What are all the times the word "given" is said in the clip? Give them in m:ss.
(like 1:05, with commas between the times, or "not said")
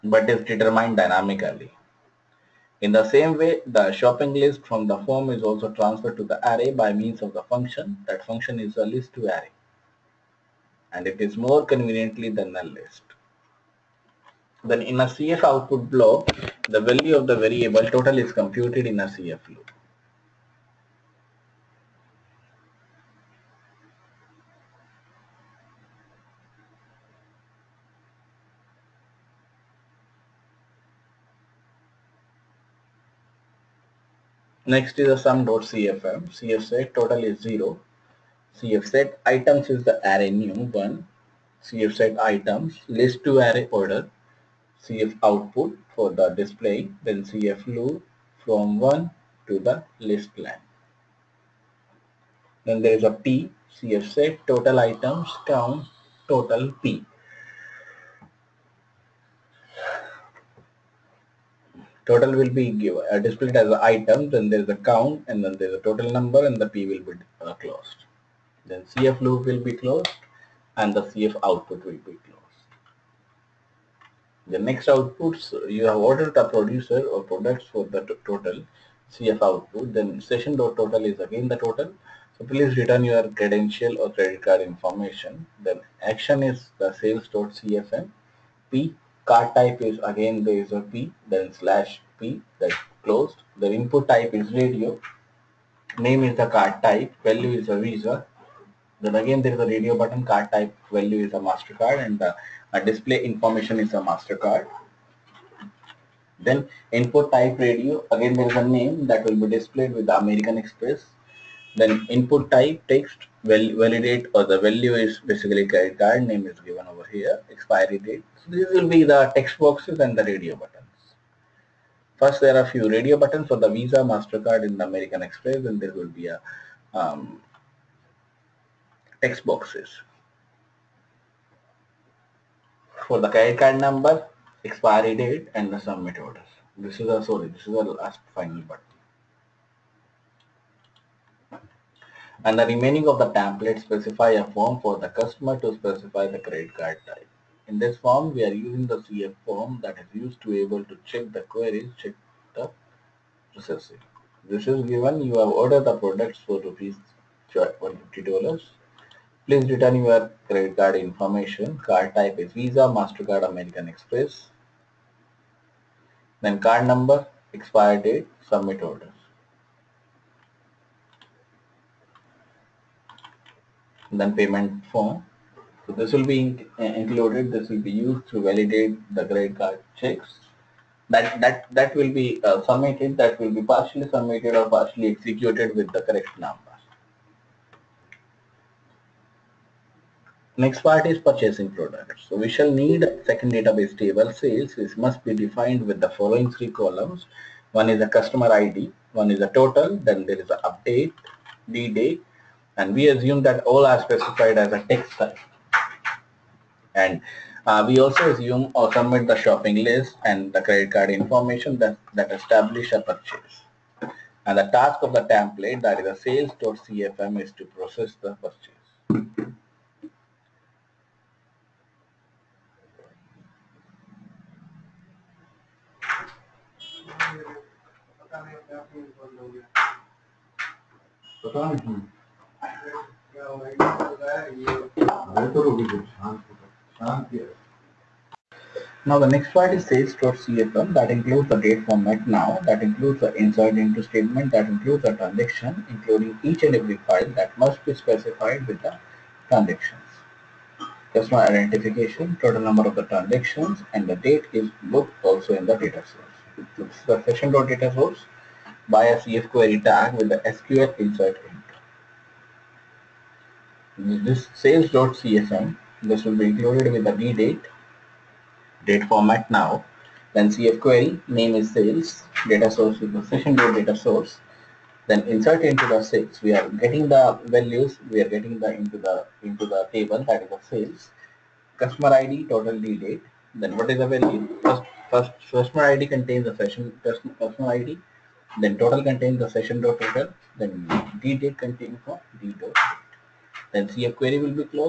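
1:02, 1:56, 2:34.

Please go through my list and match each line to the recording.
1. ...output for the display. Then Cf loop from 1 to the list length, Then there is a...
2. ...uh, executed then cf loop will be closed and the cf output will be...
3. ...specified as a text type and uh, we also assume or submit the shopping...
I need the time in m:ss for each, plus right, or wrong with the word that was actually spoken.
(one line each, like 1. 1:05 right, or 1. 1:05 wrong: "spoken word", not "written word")
1. 0:45 right
2. 1:07 wrong: "closed", not "executed"
3. 3:24 right.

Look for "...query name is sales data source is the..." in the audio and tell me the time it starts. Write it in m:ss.
4:30.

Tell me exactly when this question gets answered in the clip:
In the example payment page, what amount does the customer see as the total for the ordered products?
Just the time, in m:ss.
2:37.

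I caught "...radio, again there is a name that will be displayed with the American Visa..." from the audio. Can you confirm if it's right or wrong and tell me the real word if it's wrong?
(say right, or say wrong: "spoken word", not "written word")
wrong: "Express", not "Visa".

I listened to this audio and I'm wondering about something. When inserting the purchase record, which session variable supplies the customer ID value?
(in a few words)
session personal id.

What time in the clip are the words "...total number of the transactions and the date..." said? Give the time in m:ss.
4:12.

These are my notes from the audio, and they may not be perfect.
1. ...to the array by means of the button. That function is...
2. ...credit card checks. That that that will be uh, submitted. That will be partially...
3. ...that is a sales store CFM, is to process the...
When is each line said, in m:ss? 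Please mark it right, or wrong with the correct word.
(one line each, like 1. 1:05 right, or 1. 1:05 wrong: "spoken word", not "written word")
1. 0:06 wrong: "function", not "button"
2. 2:59 right
3. 3:35 right.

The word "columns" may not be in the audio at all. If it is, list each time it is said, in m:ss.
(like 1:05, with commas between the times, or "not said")
3:16.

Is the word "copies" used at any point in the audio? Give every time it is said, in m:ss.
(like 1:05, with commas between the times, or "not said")
not said.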